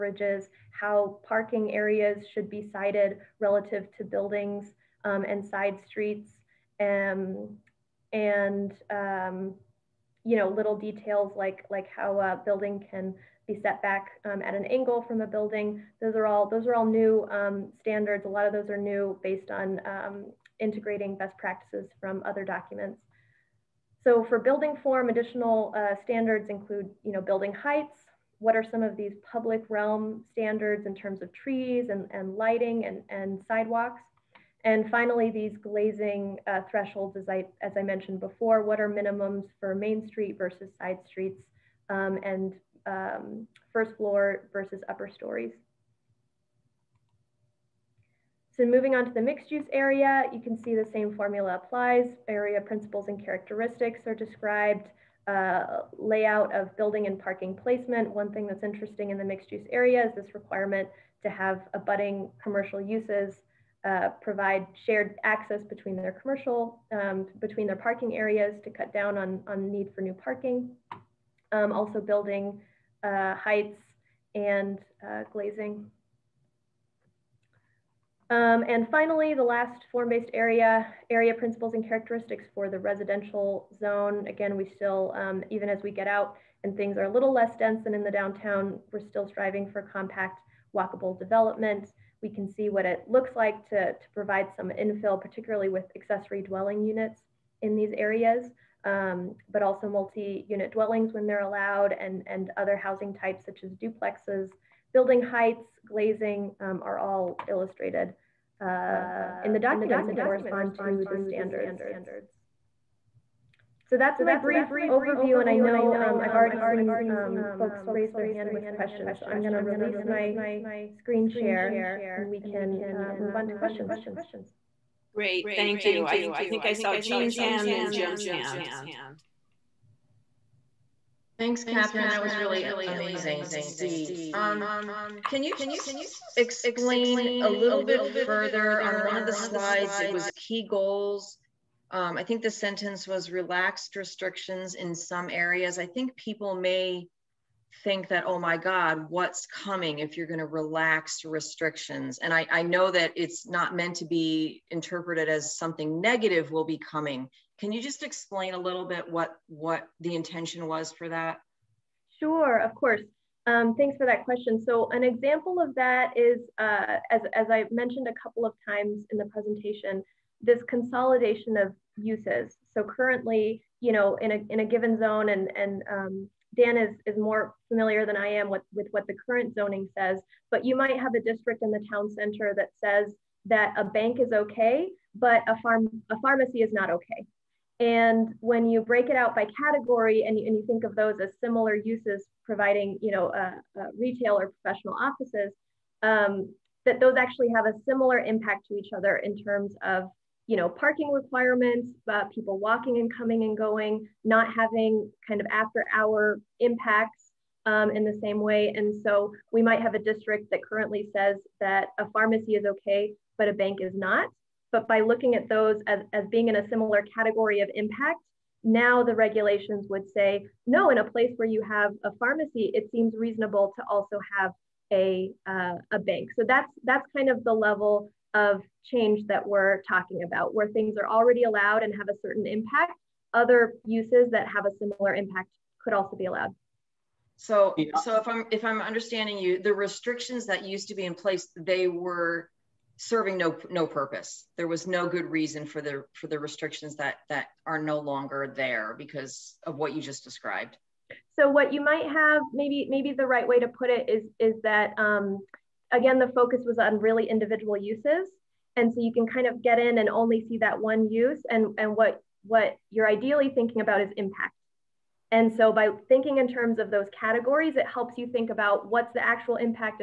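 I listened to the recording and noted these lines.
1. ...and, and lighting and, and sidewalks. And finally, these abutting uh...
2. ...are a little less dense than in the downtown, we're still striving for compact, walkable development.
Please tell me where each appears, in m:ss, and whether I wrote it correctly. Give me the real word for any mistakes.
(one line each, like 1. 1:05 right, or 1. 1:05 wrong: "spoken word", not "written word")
1. 0:31 wrong: "glazing", not "abutting"
2. 1:26 right.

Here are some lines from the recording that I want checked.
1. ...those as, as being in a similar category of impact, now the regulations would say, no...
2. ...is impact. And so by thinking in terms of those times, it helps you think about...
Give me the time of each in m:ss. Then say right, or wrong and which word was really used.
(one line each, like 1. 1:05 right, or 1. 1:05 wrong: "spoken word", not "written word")
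1. 3:35 right
2. 4:24 wrong: "categories", not "times".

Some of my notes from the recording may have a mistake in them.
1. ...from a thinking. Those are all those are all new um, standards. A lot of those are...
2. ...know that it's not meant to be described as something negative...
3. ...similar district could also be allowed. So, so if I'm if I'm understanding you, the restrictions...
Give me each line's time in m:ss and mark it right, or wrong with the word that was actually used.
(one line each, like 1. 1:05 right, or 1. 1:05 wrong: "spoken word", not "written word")
1. 0:15 wrong: "building", not "thinking"
2. 2:32 wrong: "interpreted", not "described"
3. 3:54 wrong: "impact", not "district".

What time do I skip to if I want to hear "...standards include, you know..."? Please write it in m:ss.
0:26.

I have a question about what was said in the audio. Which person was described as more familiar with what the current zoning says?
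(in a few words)
Dan.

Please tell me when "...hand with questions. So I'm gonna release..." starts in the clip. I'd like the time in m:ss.
1:58.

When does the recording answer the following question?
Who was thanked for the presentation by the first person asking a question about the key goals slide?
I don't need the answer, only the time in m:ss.
2:11.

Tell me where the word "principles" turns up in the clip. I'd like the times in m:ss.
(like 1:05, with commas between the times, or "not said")
0:52, 1:21.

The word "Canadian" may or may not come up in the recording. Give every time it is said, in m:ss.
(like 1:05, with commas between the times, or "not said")
not said.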